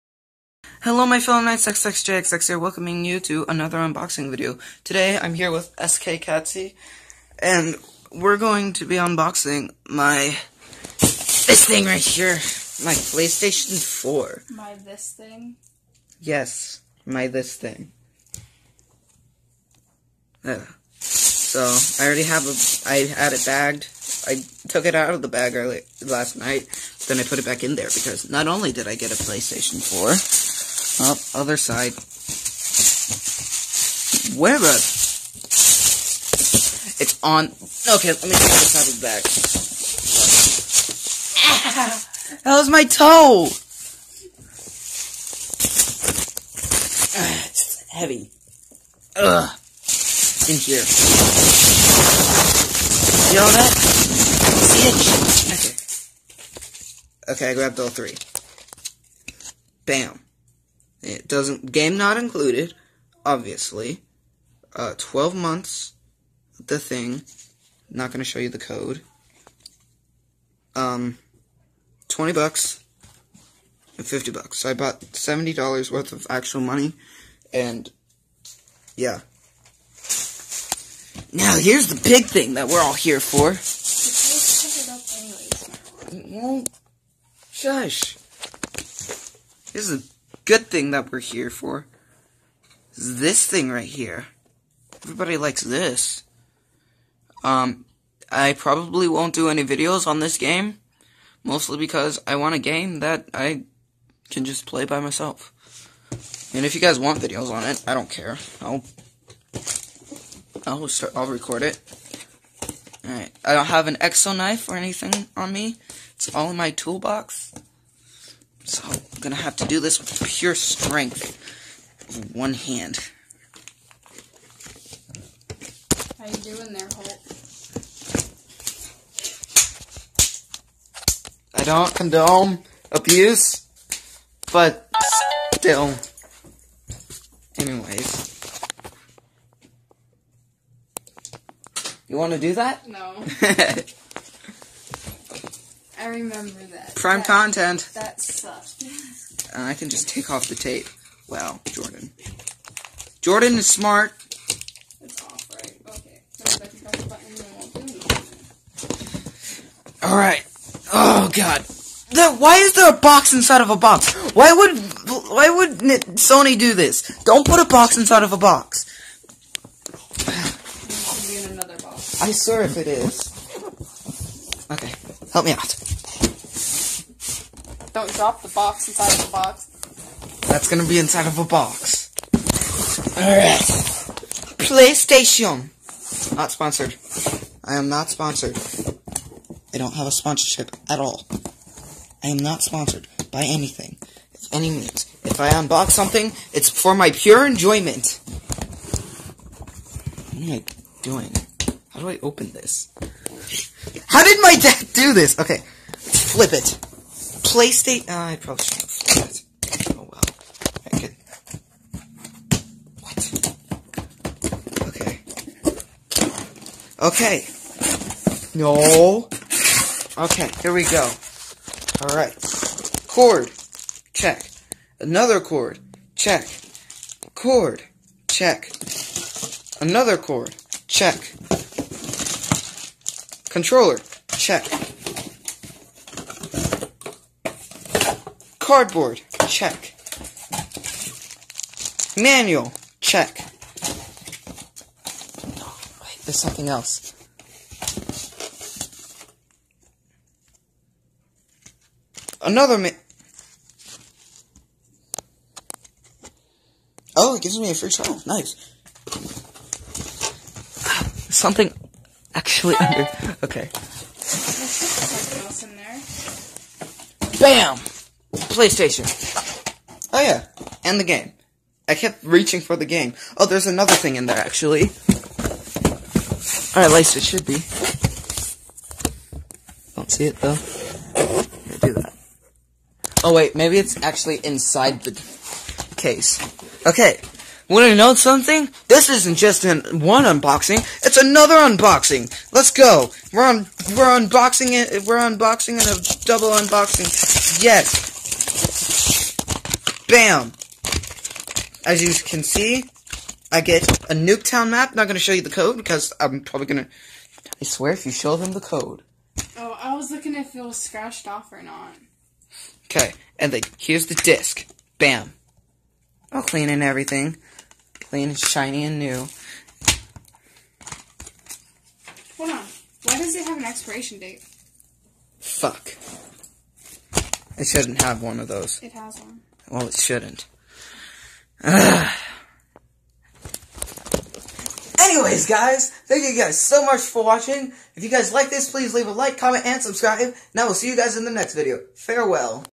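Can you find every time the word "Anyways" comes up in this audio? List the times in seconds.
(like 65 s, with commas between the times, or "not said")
137 s, 334 s.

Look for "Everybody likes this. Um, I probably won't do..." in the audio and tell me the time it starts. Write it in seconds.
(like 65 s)
95 s.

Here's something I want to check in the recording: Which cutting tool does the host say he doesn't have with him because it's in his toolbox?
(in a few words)
exo knife.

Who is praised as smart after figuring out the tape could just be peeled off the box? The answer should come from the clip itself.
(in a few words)
Jordan.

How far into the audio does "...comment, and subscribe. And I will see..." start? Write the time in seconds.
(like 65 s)
339 s.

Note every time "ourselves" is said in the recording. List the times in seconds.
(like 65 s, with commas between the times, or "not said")
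not said.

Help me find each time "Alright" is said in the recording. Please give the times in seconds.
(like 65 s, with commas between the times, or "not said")
113 s, 160 s, 183 s, 222 s.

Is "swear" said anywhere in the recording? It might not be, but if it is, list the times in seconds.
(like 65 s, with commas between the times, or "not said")
172 s, 307 s.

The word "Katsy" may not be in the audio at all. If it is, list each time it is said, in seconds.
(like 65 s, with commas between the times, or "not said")
6 s.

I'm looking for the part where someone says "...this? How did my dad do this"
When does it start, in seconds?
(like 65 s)
202 s.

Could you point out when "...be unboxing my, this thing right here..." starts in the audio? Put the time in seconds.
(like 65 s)
8 s.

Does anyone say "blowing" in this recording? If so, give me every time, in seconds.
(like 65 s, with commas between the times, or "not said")
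not said.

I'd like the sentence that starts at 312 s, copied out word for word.
Okay, and then here's the disc.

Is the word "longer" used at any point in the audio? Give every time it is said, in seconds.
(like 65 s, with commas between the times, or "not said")
not said.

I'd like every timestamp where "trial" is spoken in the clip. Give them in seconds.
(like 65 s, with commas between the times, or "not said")
257 s.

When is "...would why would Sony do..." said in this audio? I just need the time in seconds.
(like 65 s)
164 s.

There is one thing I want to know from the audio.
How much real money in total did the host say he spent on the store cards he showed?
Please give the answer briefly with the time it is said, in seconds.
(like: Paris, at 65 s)
$70, at 75 s.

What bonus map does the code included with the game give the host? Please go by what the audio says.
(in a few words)
Nuketown.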